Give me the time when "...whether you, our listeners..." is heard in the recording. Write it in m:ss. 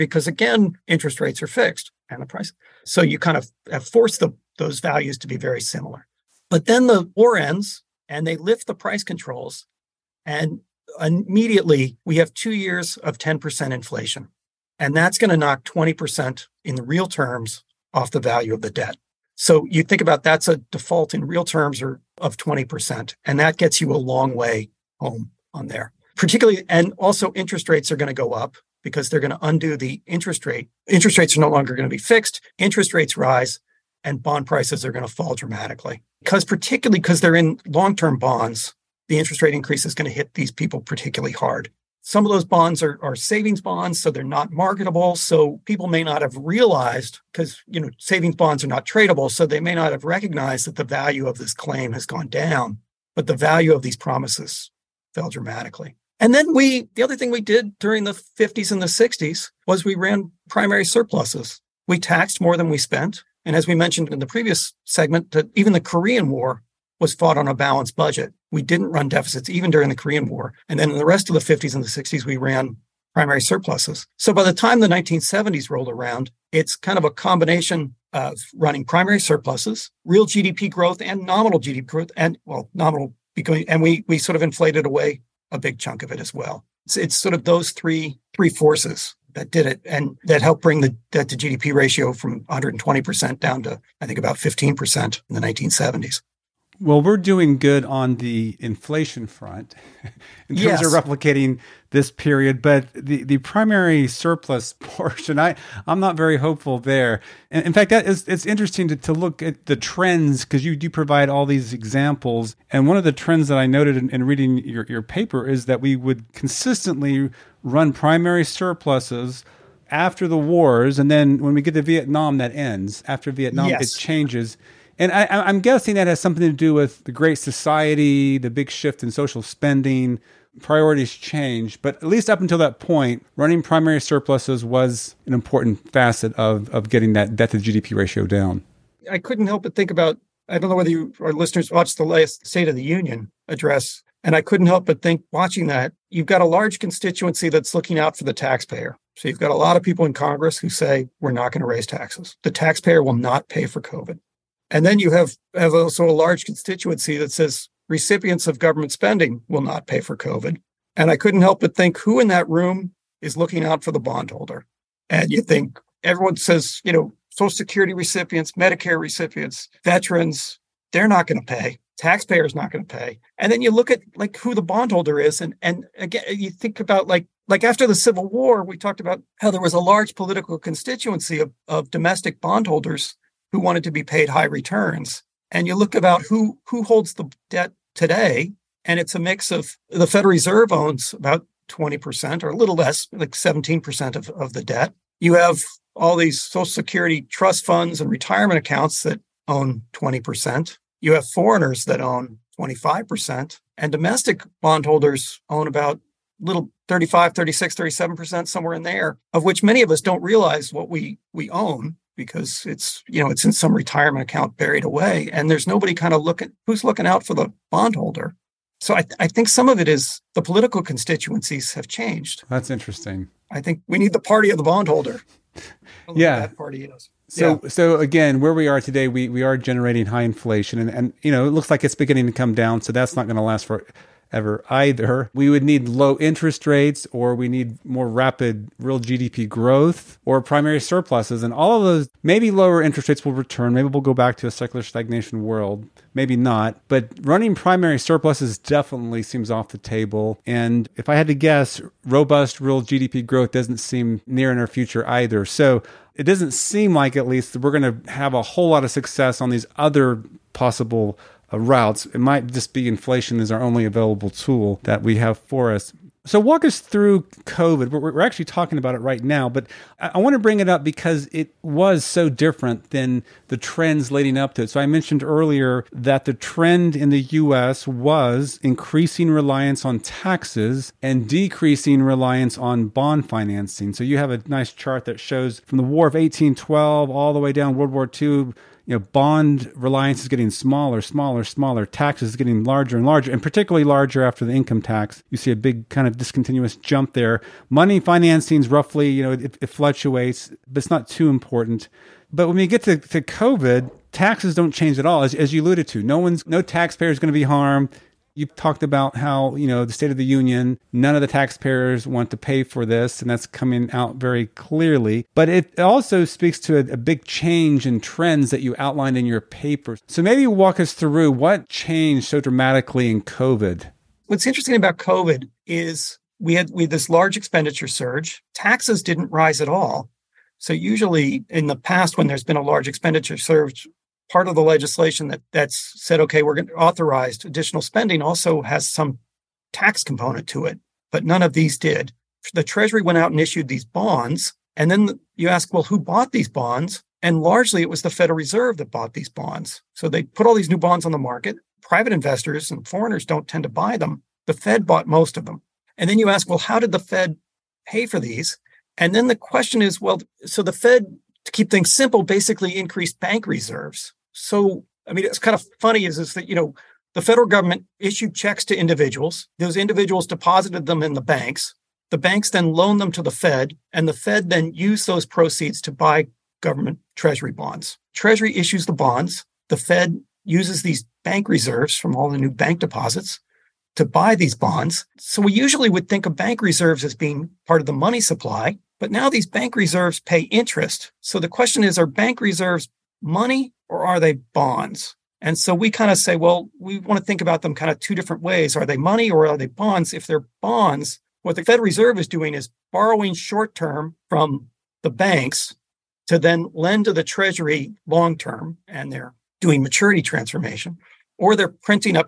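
2:20.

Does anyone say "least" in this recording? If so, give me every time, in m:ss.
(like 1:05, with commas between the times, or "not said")
2:12, 4:17.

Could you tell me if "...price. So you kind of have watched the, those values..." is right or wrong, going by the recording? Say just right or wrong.
wrong.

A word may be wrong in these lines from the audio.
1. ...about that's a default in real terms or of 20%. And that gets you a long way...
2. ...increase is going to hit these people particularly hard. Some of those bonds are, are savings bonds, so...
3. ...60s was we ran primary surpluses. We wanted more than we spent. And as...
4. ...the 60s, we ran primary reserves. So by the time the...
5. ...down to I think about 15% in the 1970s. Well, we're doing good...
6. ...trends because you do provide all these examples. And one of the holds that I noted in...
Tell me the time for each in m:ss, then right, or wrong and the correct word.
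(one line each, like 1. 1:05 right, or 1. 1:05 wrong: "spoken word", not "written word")
1. 0:20 right
2. 0:39 right
3. 0:58 wrong: "taxed", not "wanted"
4. 1:11 wrong: "surpluses", not "reserves"
5. 1:33 right
6. 1:49 wrong: "trends", not "holds".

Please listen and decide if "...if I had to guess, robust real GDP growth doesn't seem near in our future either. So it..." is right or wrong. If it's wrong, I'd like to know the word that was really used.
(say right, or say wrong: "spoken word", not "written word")
right.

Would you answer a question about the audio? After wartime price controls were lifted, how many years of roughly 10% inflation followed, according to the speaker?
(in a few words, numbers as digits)
2.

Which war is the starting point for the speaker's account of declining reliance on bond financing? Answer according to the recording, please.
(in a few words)
War of 1812.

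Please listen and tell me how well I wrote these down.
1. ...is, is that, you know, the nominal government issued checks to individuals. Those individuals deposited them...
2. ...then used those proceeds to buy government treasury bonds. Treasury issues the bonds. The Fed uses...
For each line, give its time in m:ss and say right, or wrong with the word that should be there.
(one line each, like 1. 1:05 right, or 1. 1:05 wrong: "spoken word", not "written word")
1. 6:06 wrong: "federal", not "nominal"
2. 6:14 right.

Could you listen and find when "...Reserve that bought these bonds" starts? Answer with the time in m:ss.
5:48.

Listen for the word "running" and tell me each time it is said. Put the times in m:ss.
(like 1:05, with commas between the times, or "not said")
1:18, 2:13, 4:07.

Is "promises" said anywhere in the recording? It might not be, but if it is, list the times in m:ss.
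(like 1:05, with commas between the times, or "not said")
0:53.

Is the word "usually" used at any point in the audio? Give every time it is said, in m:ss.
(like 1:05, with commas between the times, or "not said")
5:30, 6:25.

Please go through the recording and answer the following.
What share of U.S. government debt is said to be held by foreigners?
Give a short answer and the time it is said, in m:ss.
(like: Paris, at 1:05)
25%, at 3:22.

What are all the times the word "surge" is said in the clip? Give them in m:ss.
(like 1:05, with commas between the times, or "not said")
5:27, 5:33.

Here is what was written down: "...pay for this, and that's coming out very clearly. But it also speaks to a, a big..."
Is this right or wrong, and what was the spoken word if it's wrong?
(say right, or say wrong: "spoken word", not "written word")
right.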